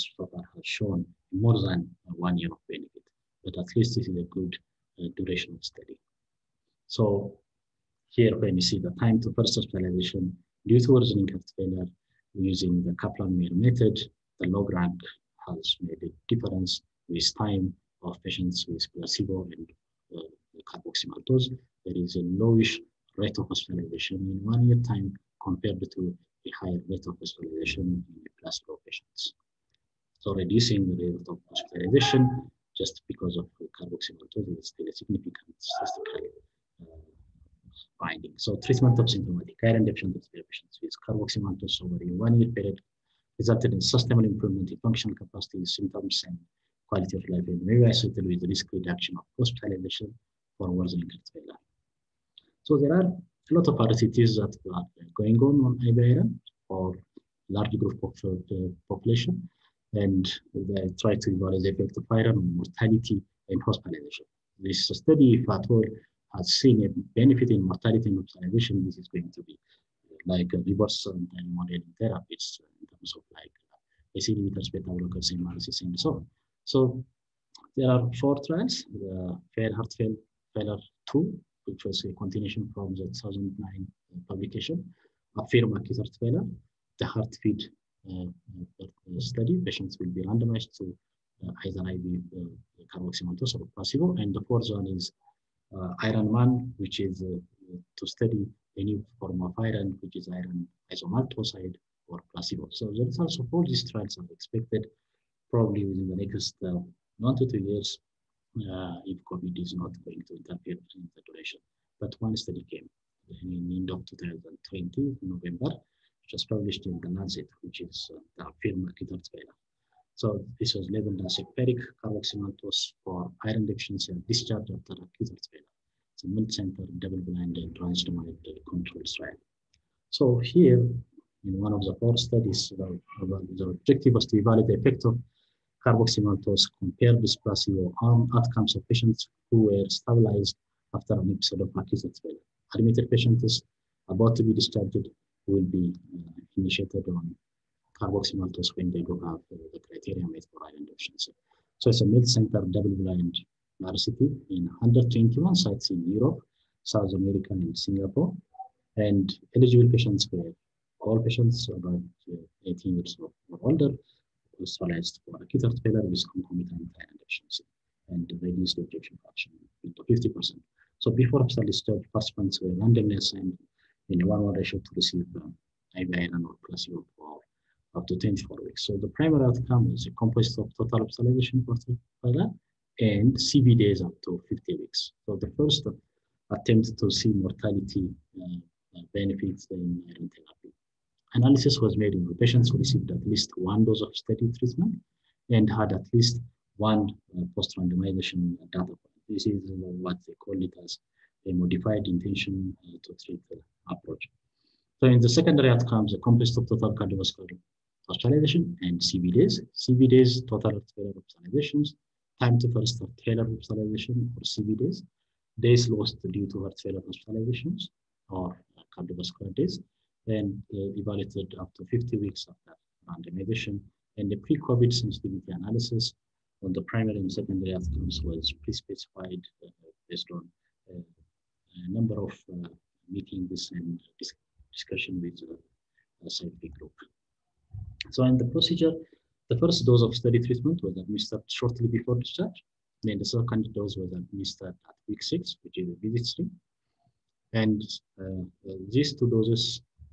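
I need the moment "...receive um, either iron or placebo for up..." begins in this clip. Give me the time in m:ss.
2:54.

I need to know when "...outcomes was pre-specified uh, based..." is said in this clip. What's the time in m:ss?
3:47.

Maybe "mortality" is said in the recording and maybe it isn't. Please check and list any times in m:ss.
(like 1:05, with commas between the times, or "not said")
1:02, 1:07, 3:07.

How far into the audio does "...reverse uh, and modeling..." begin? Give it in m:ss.
1:10.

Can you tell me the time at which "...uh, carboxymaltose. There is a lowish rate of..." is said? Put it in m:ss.
0:20.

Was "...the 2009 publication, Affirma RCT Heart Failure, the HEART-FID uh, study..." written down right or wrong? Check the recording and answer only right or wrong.
wrong.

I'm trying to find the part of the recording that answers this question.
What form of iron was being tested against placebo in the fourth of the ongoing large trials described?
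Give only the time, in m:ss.
1:40.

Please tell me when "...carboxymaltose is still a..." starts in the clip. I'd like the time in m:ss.
0:33.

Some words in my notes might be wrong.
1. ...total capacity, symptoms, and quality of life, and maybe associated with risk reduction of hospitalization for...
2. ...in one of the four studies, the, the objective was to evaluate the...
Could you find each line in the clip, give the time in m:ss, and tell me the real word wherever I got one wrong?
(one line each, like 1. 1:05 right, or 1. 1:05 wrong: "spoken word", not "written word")
1. 0:44 wrong: "functional", not "total"
2. 2:11 right.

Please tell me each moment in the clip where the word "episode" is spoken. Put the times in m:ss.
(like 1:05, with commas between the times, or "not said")
2:21.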